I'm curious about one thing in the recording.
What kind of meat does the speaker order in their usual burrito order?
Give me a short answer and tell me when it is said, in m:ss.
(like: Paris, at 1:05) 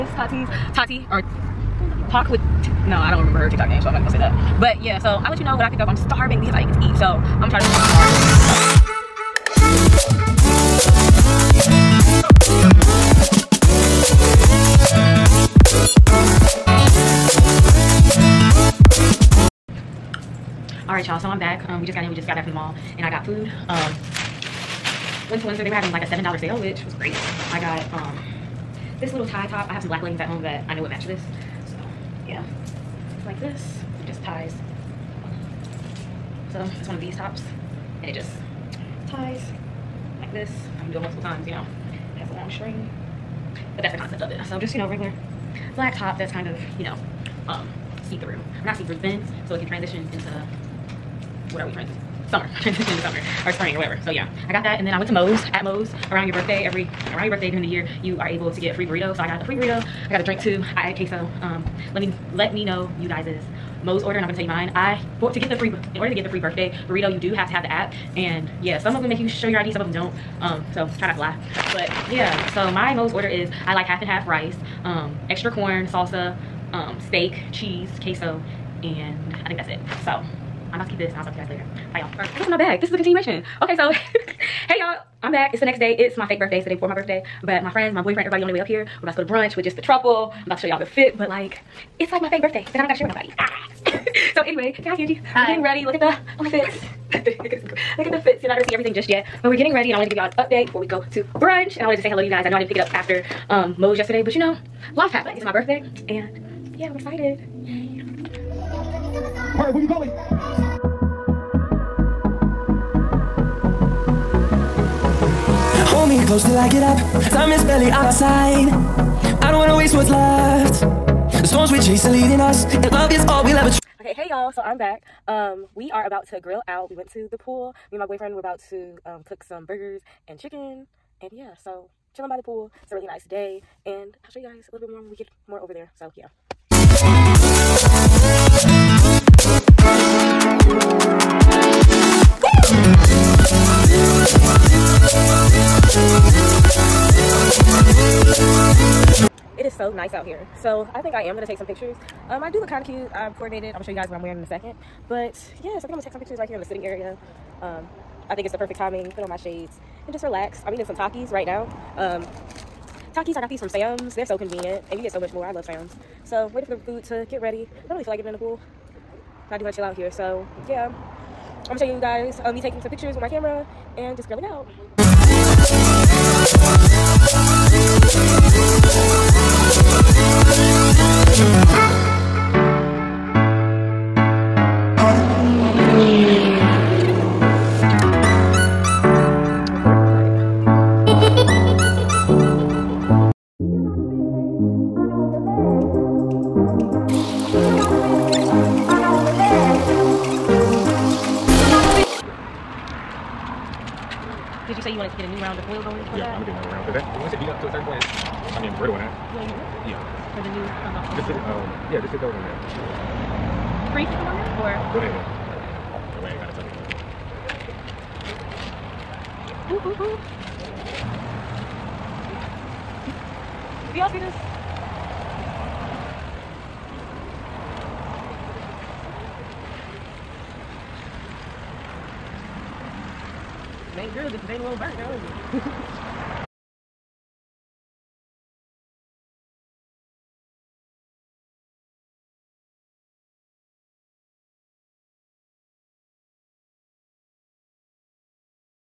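Steak, at 1:17.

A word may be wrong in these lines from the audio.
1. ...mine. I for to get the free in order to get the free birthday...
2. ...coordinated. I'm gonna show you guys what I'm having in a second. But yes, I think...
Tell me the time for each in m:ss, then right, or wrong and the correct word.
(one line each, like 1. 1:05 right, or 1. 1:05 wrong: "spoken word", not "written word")
1. 1:04 right
2. 2:33 wrong: "wearing", not "having".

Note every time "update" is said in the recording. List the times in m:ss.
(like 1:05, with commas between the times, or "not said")
1:40.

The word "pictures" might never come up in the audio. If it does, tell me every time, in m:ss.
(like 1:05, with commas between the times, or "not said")
2:31, 2:36, 2:52.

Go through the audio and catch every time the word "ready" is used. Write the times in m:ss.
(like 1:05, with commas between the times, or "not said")
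1:35, 1:39, 2:47.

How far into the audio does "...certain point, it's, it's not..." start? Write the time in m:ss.
3:27.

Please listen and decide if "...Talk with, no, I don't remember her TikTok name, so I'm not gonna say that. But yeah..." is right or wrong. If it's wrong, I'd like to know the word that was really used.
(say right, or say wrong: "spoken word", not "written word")
right.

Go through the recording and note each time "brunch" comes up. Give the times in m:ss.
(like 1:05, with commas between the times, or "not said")
1:29, 1:41.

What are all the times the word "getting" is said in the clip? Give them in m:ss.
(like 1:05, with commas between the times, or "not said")
1:35, 1:39, 2:48, 3:28.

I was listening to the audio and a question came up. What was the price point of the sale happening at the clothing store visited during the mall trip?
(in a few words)
$7.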